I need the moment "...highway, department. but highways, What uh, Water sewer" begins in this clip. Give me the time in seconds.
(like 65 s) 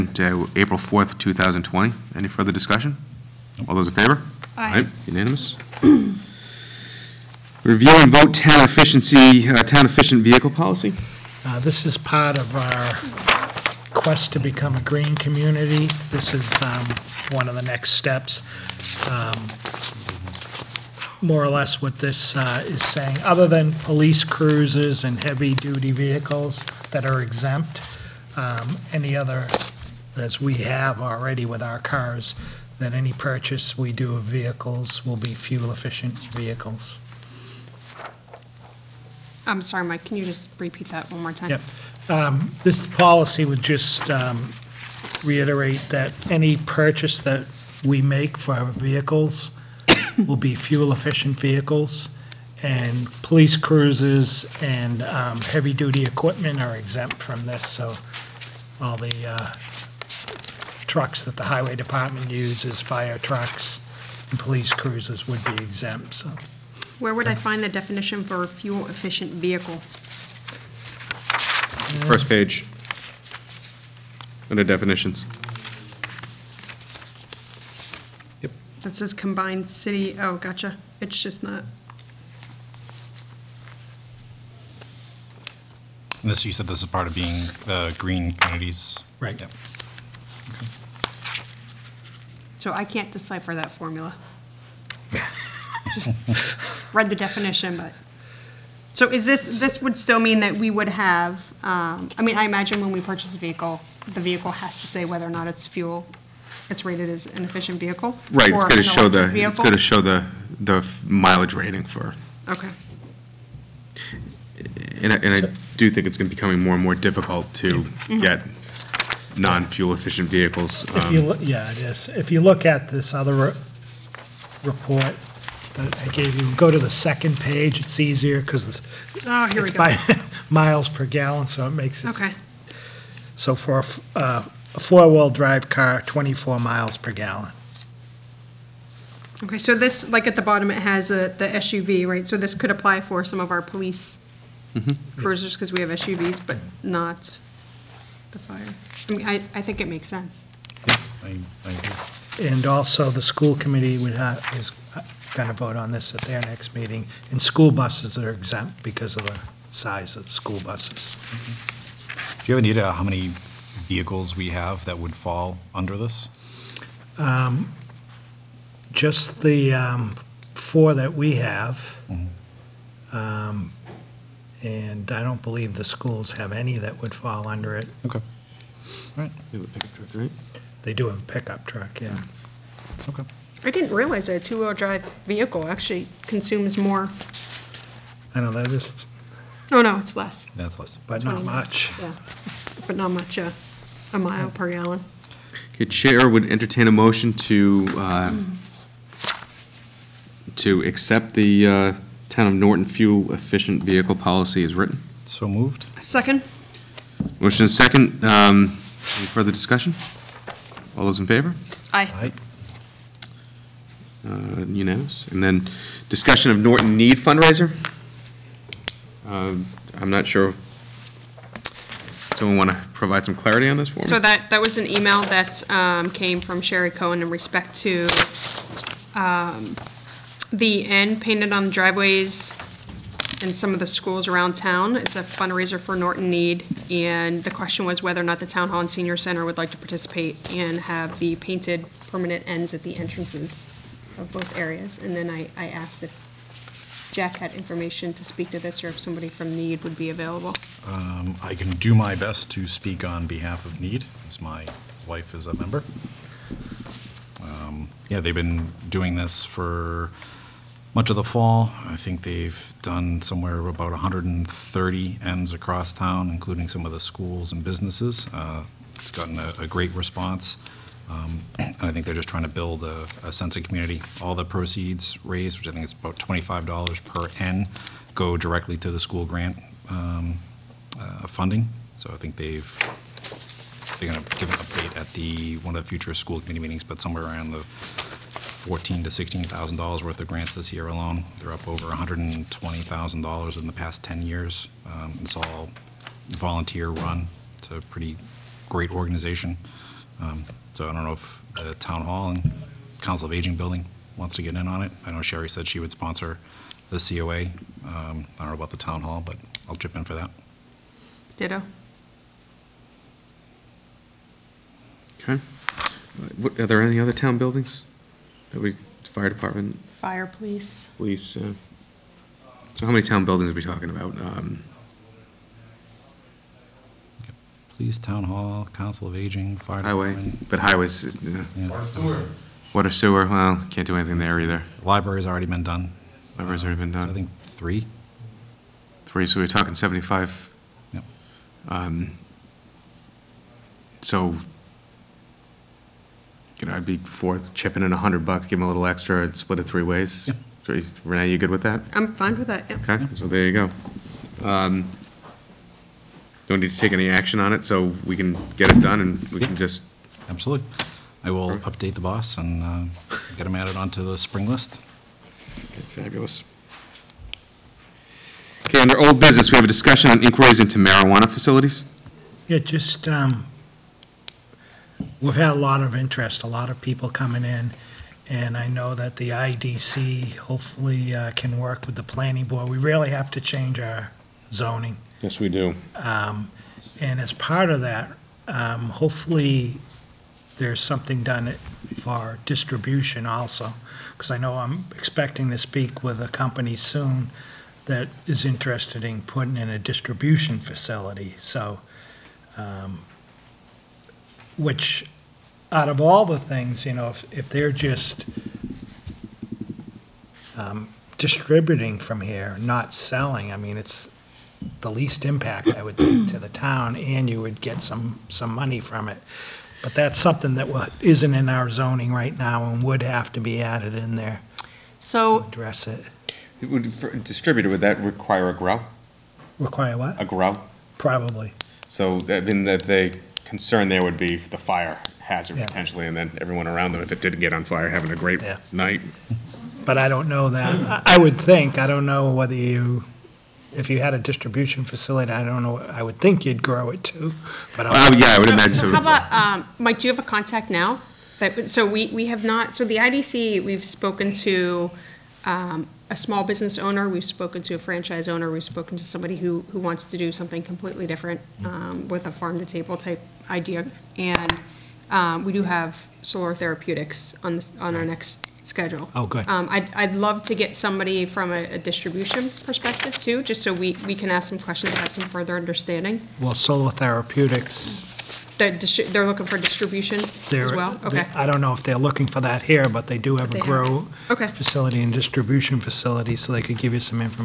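329 s.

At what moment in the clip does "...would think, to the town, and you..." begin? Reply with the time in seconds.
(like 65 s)
415 s.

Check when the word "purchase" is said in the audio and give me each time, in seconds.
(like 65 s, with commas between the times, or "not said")
33 s, 46 s, 103 s.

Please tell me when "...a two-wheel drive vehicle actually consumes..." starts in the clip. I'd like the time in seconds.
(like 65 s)
184 s.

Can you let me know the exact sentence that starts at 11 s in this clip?
Uh, this is part of our quest to become a green community.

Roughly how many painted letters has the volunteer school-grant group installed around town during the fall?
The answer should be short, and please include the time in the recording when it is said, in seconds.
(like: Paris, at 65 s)
130, at 263 s.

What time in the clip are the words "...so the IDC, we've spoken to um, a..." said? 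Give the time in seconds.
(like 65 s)
452 s.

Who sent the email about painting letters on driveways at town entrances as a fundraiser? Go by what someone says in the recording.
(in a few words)
Sherry Cohen.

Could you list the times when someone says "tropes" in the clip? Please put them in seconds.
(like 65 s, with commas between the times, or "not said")
not said.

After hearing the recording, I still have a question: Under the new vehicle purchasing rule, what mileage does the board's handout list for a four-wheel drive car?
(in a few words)
24 miles per gallon.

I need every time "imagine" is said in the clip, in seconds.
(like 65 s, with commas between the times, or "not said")
102 s, 448 s.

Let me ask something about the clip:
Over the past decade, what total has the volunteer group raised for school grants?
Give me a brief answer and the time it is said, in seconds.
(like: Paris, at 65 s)
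120 thousand dollars, at 291 s.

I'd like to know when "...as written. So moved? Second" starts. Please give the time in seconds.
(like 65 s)
204 s.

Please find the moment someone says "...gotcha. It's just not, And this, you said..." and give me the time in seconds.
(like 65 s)
80 s.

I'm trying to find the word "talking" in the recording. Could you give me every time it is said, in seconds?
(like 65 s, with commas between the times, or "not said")
323 s, 339 s.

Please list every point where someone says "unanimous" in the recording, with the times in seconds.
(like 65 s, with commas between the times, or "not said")
5 s, 214 s.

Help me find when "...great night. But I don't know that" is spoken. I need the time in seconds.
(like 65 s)
438 s.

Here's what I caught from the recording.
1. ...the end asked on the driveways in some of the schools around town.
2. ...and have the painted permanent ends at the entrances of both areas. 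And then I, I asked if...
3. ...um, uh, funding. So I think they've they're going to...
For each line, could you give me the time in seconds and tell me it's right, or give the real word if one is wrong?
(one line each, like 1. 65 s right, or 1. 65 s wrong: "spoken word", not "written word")
1. 230 s wrong: "painted", not "asked"
2. 240 s right
3. 279 s right.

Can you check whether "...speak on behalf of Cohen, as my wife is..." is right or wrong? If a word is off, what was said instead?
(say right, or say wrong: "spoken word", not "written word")
wrong: "Need", not "Cohen".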